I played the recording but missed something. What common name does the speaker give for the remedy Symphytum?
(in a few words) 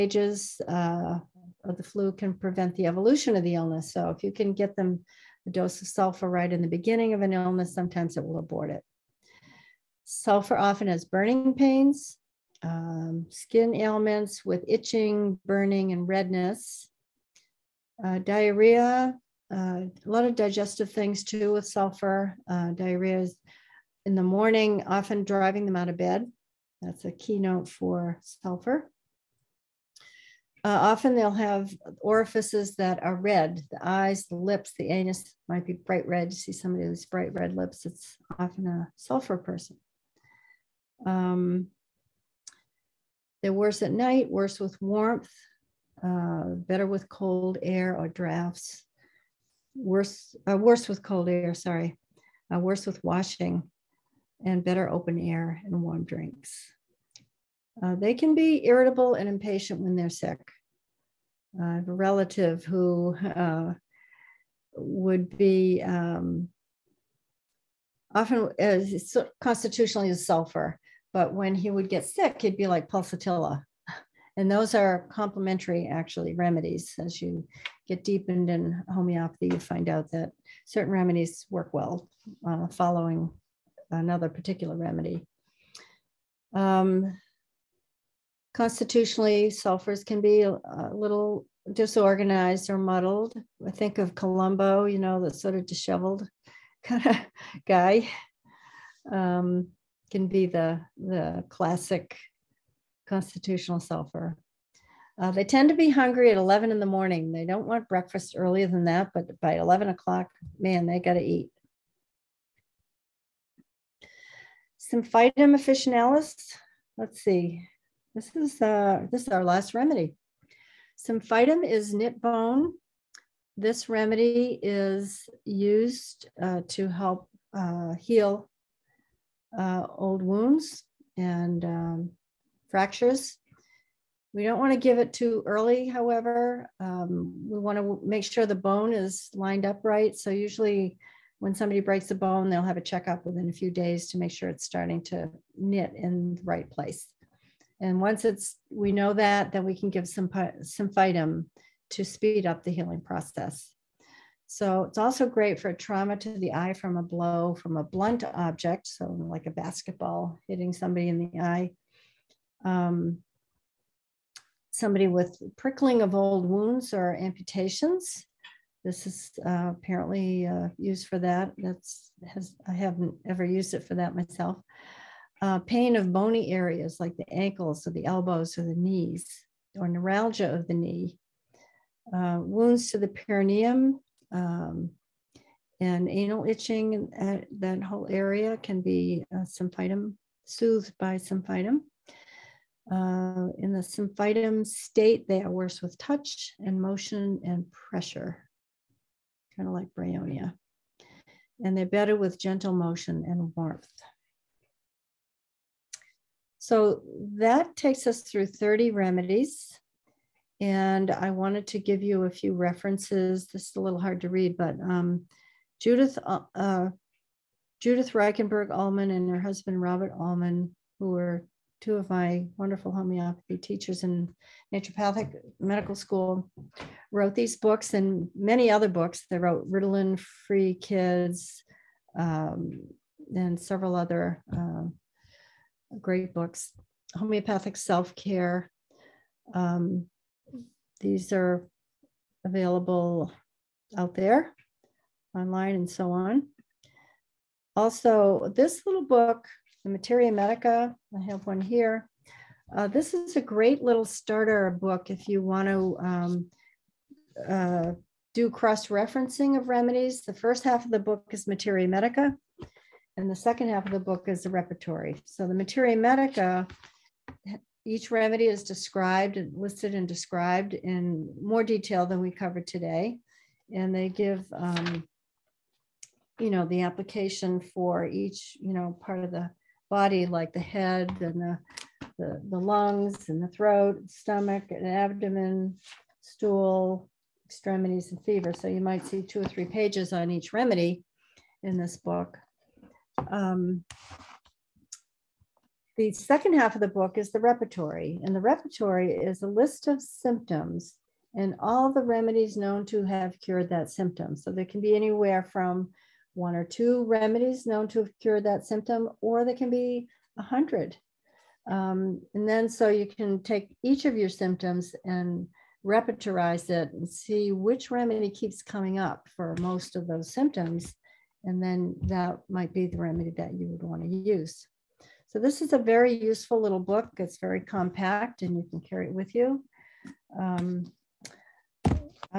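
Knit bone.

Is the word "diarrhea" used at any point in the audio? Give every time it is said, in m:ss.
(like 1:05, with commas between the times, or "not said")
0:18, 0:22.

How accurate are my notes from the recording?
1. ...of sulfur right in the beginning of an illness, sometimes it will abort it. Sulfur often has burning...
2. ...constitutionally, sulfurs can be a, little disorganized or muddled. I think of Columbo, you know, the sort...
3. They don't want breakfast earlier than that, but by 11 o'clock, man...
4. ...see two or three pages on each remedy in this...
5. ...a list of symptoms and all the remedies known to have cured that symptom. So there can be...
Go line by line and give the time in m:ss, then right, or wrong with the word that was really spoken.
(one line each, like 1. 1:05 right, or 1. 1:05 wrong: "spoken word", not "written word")
1. 0:05 right
2. 1:28 right
3. 1:47 right
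4. 4:49 right
5. 4:59 right.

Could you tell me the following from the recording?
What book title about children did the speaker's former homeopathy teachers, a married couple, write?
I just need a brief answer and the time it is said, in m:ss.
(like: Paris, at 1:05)
Ritalin Free Kids, at 3:49.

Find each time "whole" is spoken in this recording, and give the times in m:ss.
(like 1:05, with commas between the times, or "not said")
3:07.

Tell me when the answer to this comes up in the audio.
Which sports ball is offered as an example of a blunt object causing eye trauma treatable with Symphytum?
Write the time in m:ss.
2:39.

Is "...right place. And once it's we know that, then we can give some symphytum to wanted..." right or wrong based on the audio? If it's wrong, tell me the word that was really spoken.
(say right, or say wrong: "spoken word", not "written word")
wrong: "speed", not "wanted".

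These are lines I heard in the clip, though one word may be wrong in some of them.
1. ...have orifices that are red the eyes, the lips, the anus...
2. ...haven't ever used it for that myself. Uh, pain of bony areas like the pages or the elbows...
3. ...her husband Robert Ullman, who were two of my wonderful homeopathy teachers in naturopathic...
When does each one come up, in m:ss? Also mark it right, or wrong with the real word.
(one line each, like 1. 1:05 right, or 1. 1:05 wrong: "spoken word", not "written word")
1. 0:31 right
2. 2:52 wrong: "ankles", not "pages"
3. 3:39 right.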